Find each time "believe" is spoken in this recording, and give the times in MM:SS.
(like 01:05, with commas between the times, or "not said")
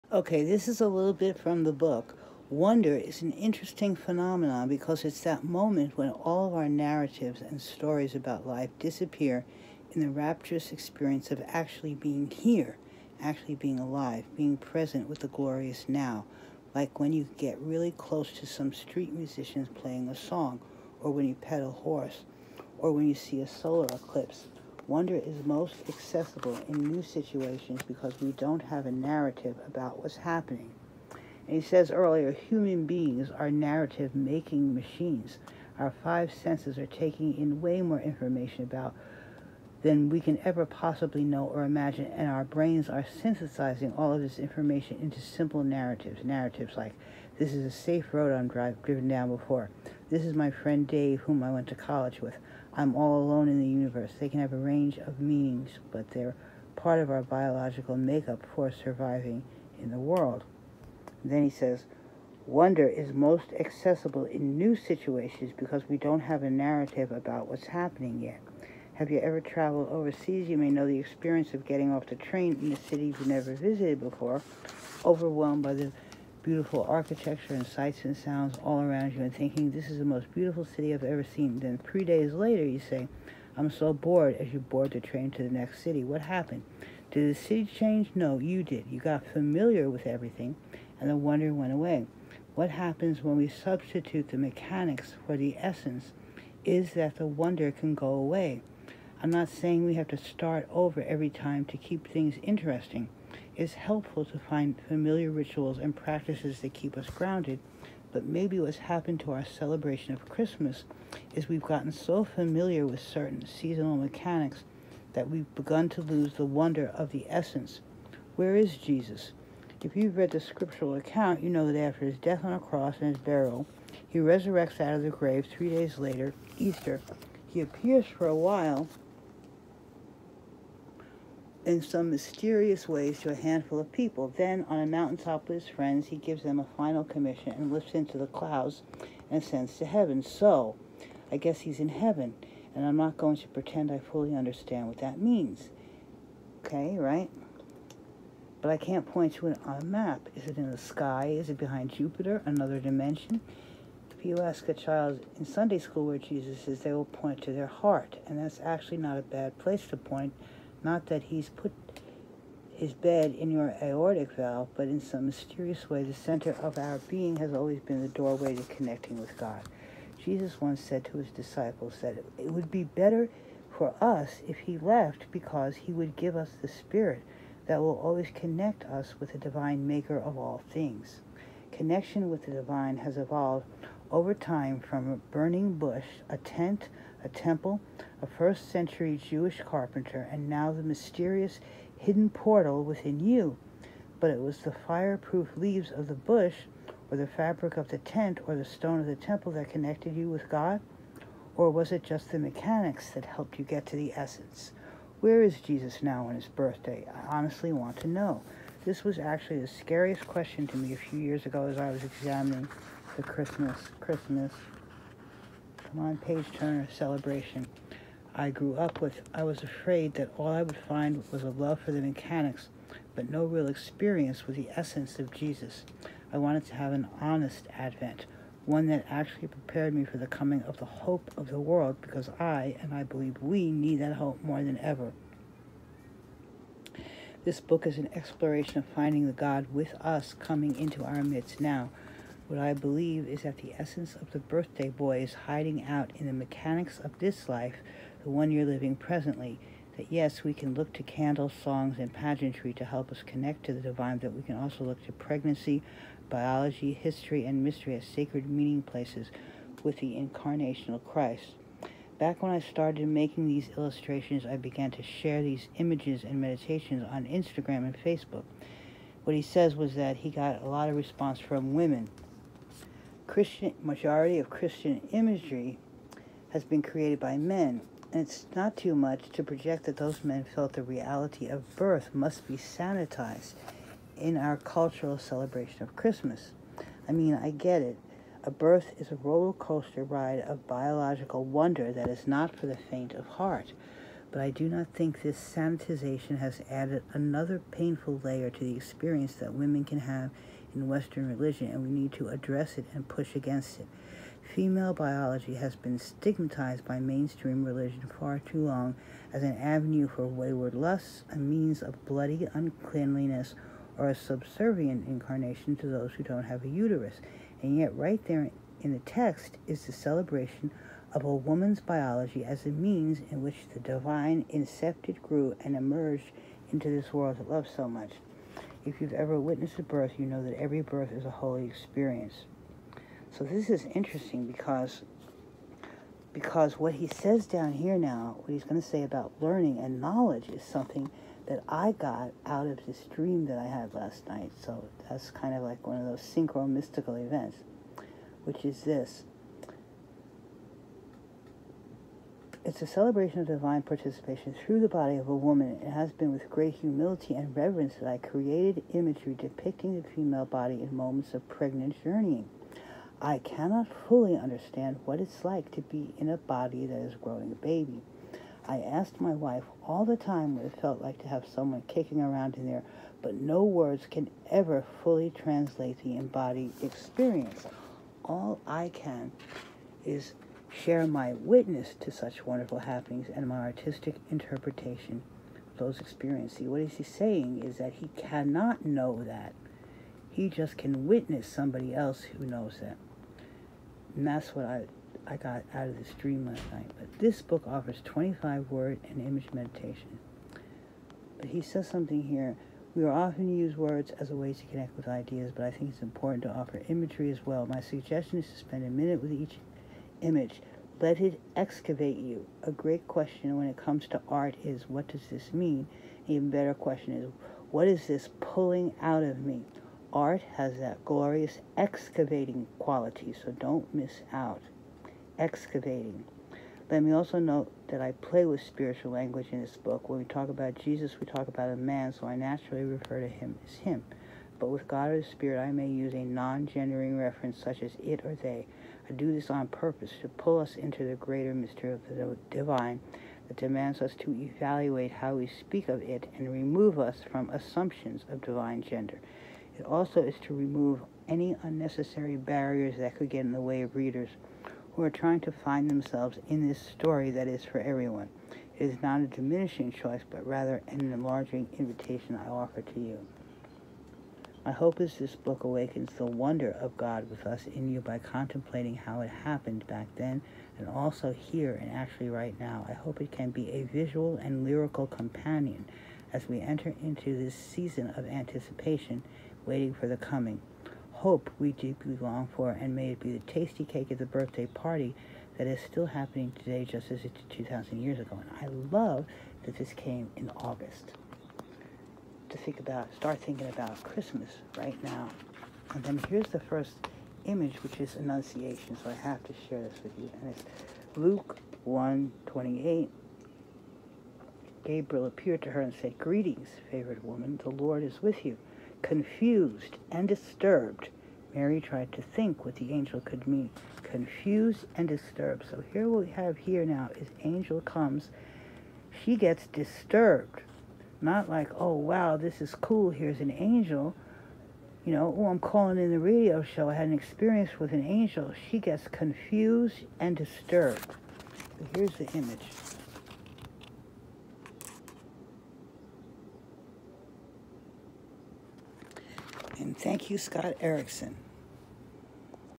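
03:53, 04:02.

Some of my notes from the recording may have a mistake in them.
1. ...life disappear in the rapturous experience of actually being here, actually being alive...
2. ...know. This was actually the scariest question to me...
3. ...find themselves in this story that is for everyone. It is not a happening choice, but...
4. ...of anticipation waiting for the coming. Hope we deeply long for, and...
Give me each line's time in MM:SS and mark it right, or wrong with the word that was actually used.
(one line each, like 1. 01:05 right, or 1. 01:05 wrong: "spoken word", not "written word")
1. 00:08 right
2. 03:28 right
3. 07:35 wrong: "diminishing", not "happening"
4. 07:58 right.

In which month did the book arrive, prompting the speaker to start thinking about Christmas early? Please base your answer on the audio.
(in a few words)
August.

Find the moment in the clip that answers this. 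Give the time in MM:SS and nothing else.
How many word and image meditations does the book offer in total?
06:38.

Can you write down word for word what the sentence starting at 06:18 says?
All I can is share my witness to such wonderful happenings and my artistic interpretation of those experiences.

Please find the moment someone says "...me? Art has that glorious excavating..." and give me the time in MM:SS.
06:59.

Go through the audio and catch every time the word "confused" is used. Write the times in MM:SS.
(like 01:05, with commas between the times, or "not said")
08:29, 08:34, 08:49.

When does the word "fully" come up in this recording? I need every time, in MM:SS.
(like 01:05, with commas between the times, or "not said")
02:23, 06:04, 06:15.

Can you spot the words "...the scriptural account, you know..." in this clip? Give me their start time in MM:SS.
02:00.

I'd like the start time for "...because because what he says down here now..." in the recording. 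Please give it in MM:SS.
05:34.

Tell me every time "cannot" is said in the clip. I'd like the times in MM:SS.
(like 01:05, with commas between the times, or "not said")
06:03, 06:28.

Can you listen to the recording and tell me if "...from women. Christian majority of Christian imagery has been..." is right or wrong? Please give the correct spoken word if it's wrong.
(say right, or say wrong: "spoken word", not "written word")
right.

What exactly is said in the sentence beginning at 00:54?
They can have a range of meanings, but they're part of our biological makeup for surviving in the world.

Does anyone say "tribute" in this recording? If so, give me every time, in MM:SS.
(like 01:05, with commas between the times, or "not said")
not said.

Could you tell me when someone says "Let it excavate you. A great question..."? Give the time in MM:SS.
06:50.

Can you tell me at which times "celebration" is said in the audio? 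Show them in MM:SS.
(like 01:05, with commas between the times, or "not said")
01:49, 03:36, 04:45, 05:19, 05:52.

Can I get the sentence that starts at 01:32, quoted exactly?
What happens when we substitute the mechanics for the essence is that the wonder can go away.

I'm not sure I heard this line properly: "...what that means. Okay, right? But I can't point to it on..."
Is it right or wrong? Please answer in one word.
right.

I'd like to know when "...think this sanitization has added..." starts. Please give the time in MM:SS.
04:54.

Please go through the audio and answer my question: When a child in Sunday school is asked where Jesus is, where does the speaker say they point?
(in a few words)
Their heart.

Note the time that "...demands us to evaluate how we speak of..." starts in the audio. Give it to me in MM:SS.
07:23.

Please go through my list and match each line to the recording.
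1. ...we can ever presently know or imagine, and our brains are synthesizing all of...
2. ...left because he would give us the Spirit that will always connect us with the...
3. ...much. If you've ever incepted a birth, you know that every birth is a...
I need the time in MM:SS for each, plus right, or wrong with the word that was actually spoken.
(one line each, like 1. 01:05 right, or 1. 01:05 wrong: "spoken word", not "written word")
1. 00:40 wrong: "possibly", not "presently"
2. 02:54 right
3. 05:27 wrong: "witnessed", not "incepted".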